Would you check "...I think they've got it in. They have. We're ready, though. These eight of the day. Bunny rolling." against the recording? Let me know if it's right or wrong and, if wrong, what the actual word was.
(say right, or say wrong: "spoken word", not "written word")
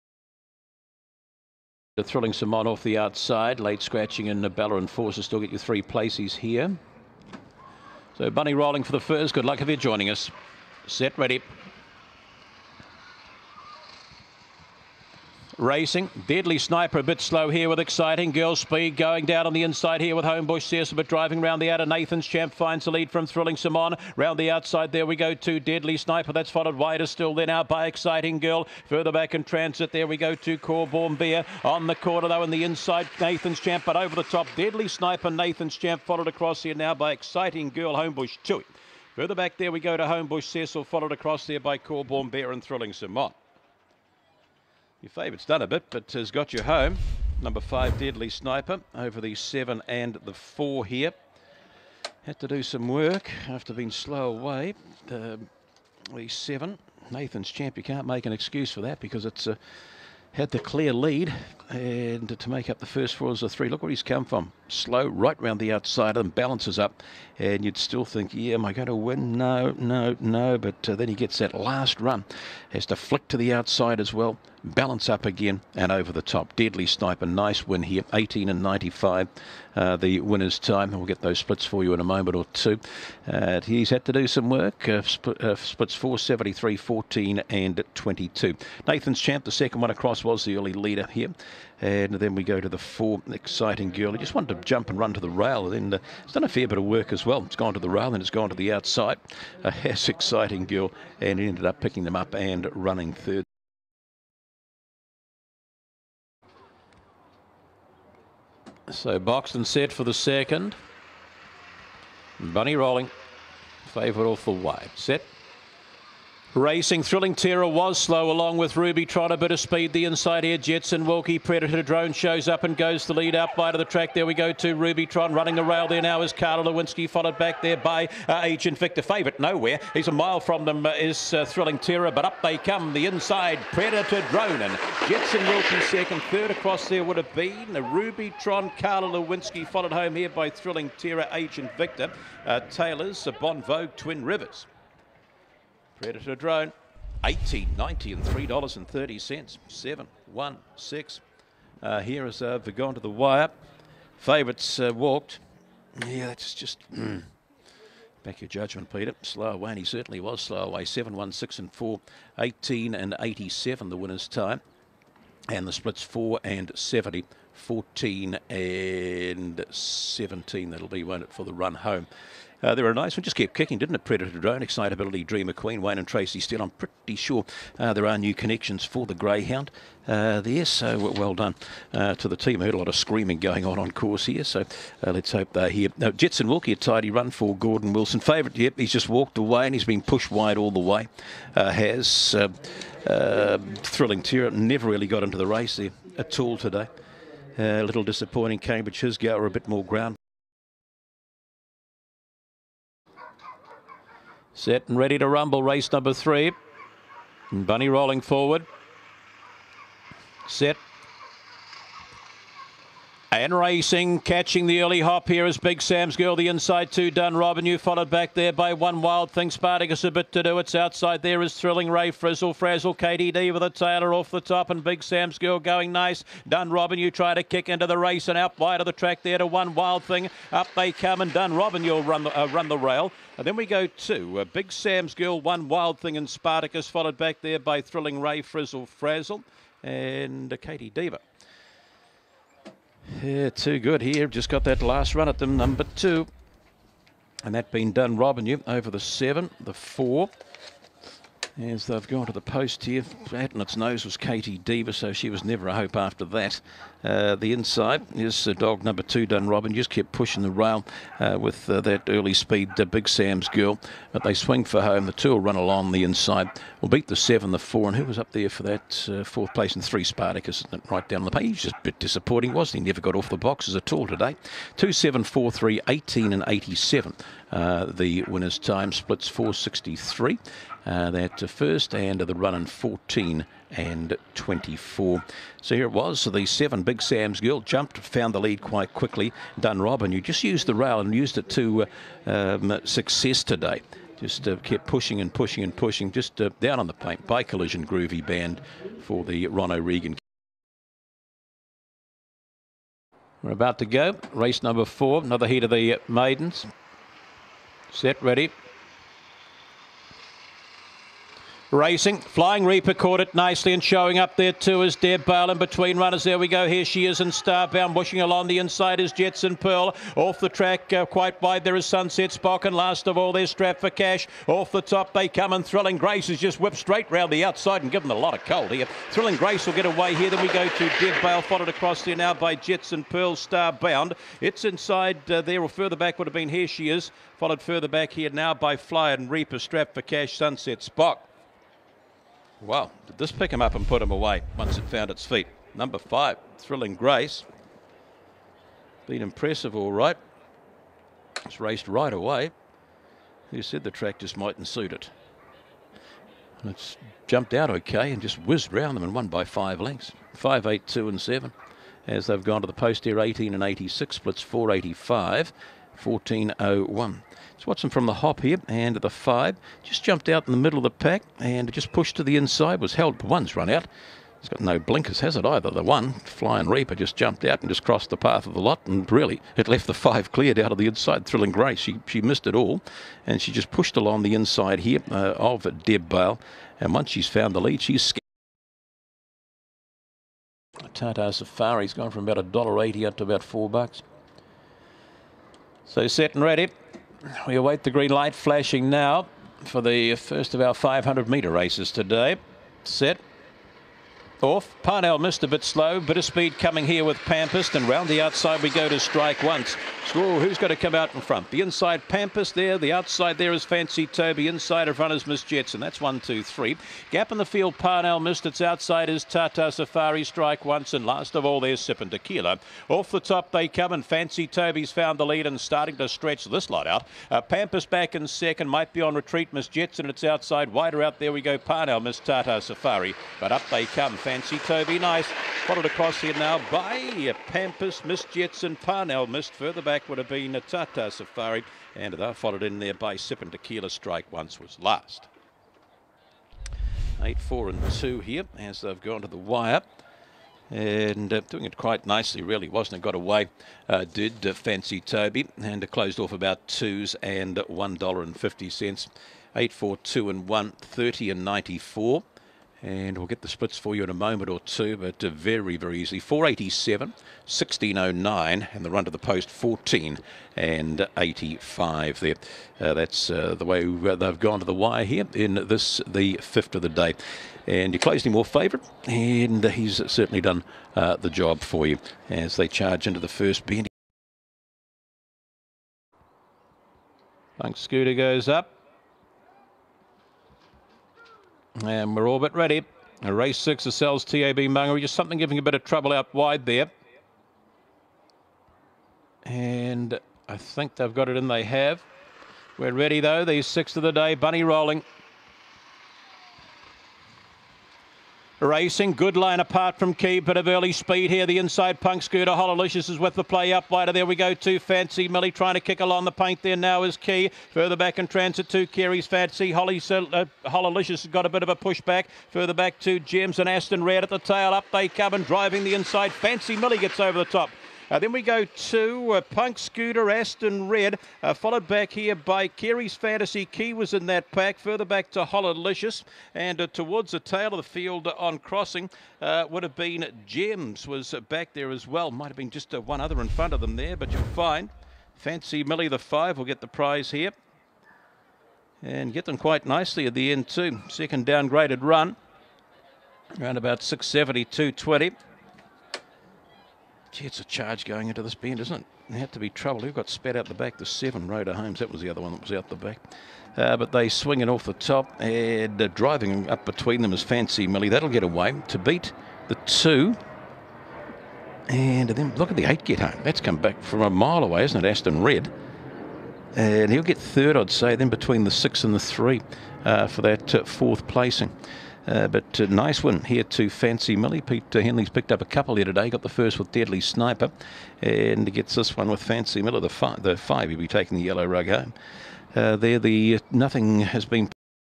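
wrong: "six", not "eight".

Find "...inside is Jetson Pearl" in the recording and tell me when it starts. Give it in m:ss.
5:18.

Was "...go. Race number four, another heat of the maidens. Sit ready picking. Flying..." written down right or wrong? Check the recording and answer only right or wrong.
wrong.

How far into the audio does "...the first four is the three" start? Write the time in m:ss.
1:02.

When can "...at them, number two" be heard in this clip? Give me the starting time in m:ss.
4:05.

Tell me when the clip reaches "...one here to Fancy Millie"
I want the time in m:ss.
9:43.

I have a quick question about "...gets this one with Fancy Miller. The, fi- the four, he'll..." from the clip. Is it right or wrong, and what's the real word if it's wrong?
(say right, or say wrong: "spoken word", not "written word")
wrong: "five", not "four".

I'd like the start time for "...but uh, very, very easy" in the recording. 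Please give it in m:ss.
7:44.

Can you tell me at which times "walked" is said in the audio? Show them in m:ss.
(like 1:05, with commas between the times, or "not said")
2:34, 3:09.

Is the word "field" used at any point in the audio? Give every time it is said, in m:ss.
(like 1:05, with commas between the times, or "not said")
6:57, 8:57.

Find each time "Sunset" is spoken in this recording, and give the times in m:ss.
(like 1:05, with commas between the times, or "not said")
5:21, 5:40.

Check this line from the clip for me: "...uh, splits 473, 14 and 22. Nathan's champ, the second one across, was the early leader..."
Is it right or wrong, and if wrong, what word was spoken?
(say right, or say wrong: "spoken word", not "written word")
right.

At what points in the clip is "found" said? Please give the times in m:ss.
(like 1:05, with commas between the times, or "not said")
4:47, 5:44, 6:27, 7:04.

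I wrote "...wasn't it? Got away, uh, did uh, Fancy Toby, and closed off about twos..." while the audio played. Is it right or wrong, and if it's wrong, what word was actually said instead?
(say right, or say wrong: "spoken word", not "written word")
right.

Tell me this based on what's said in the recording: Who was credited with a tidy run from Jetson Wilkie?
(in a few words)
Gordon Wilson.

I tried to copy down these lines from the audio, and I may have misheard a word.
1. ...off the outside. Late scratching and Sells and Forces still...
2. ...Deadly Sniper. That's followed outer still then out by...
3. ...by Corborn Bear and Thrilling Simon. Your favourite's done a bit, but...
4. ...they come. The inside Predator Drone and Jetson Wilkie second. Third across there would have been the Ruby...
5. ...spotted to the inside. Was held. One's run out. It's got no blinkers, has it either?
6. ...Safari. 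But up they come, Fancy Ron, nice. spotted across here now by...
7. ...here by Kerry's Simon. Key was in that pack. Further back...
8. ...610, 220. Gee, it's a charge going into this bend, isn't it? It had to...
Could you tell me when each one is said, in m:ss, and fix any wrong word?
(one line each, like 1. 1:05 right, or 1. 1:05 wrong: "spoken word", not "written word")
1. 0:02 wrong: "Nabella", not "Sells"
2. 0:25 wrong: "wider", not "outer"
3. 0:41 right
4. 2:12 right
5. 6:11 wrong: "pushed", not "spotted"
6. 7:12 wrong: "Toby", not "Ron"
7. 8:52 wrong: "Fantasy", not "Simon"
8. 9:14 wrong: "670", not "610".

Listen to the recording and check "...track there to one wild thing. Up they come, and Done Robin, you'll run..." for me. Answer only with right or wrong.
right.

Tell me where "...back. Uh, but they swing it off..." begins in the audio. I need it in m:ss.
9:22.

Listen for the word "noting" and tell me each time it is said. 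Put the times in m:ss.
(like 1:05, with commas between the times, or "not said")
not said.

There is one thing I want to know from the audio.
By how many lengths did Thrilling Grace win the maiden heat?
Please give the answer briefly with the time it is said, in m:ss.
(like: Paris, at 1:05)
5, at 5:59.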